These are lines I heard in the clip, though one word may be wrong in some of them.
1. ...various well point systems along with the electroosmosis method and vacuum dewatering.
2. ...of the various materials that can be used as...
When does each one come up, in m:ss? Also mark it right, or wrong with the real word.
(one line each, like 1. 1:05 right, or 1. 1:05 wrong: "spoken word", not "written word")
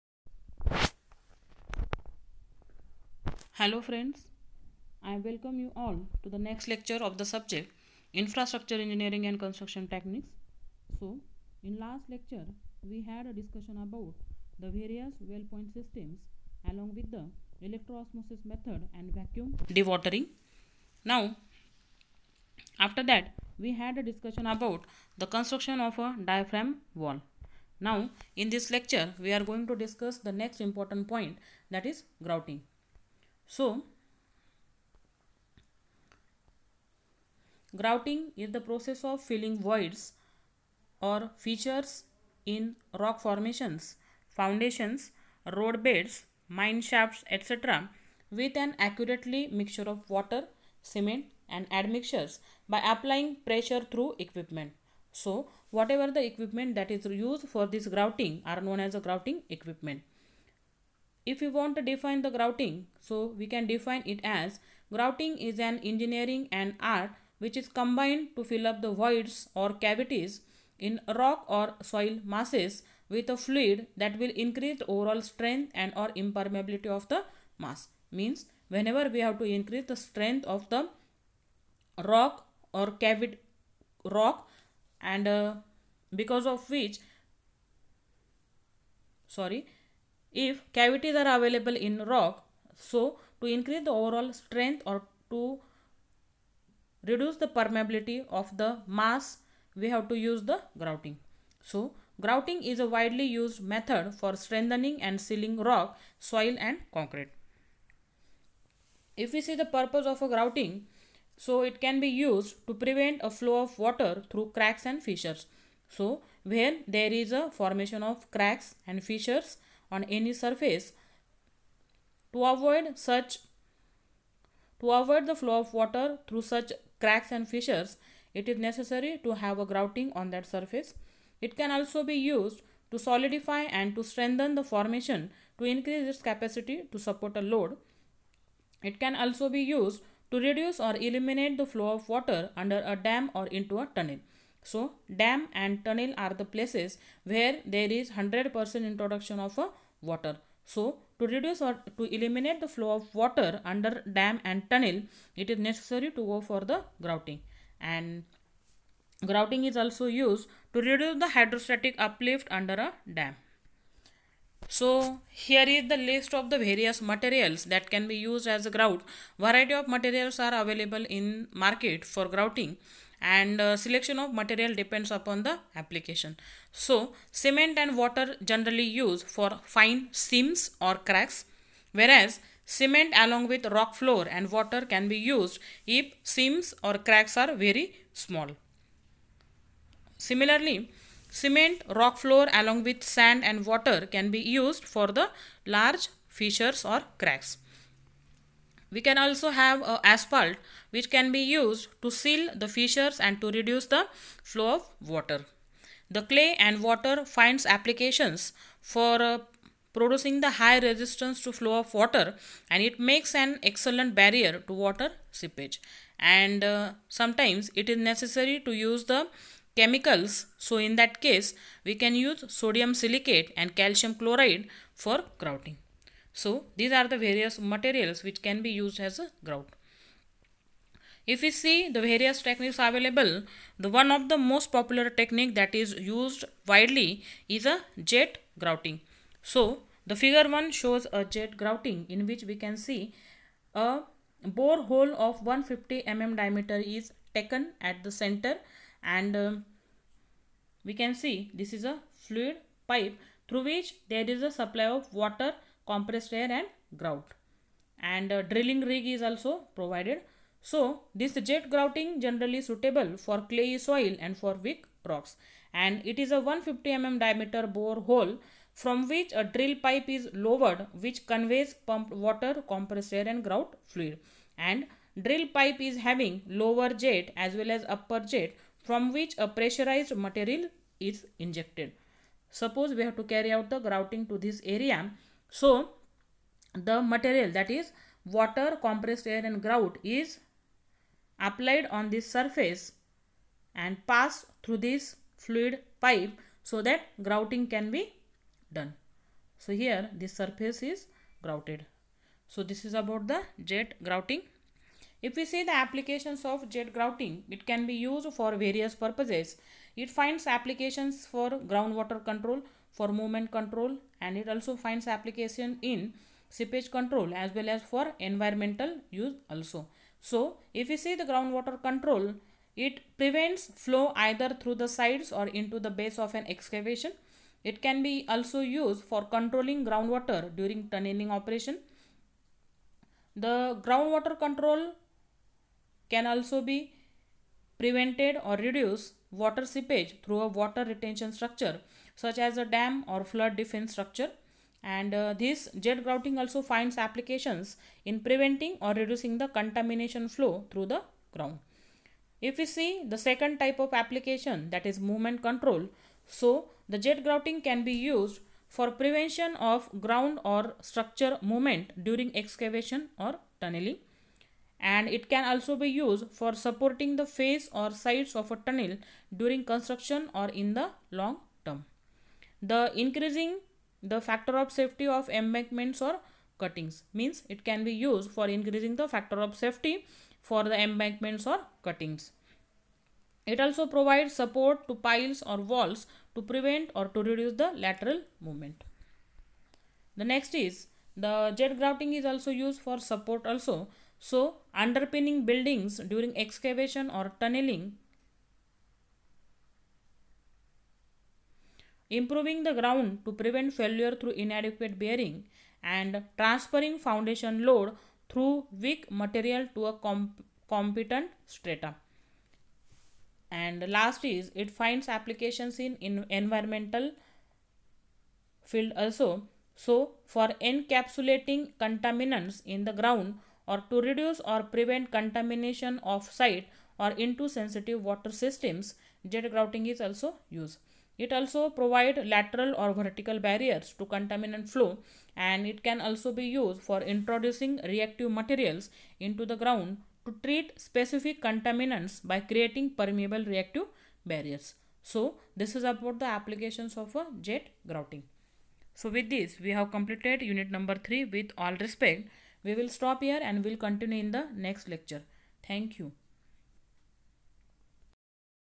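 1. 0:14 right
2. 2:46 right.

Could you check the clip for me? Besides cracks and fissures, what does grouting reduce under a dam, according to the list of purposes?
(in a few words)
Hydrostatic uplift.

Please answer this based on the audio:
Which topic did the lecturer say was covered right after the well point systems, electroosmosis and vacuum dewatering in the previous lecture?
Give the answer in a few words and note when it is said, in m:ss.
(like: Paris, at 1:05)
Diaphragm wall, at 0:26.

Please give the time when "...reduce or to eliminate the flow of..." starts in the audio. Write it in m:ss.
2:31.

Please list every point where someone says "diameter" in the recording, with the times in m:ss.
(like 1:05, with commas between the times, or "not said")
4:06, 4:27.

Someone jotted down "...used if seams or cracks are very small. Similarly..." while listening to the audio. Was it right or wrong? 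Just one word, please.
right.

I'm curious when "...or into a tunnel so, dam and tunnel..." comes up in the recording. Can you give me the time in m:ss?
2:23.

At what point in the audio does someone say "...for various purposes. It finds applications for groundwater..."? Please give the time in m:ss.
5:08.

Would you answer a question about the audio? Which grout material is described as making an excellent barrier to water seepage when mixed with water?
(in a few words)
Clay.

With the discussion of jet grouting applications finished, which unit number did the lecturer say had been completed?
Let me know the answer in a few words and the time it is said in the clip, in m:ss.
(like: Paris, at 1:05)
3, at 7:30.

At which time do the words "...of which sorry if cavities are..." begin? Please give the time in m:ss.
1:26.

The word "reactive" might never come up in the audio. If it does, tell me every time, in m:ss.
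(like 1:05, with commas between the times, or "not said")
7:17, 7:23.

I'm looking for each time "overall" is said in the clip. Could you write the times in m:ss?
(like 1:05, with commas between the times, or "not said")
1:14, 1:33.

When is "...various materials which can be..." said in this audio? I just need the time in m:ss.
3:47.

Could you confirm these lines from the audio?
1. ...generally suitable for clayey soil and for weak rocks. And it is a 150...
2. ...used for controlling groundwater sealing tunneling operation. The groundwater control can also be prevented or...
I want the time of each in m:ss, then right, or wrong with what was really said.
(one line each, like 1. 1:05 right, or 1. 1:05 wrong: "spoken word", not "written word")
1. 4:22 right
2. 5:28 wrong: "during", not "sealing".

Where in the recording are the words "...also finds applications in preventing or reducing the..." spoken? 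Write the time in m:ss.
5:46.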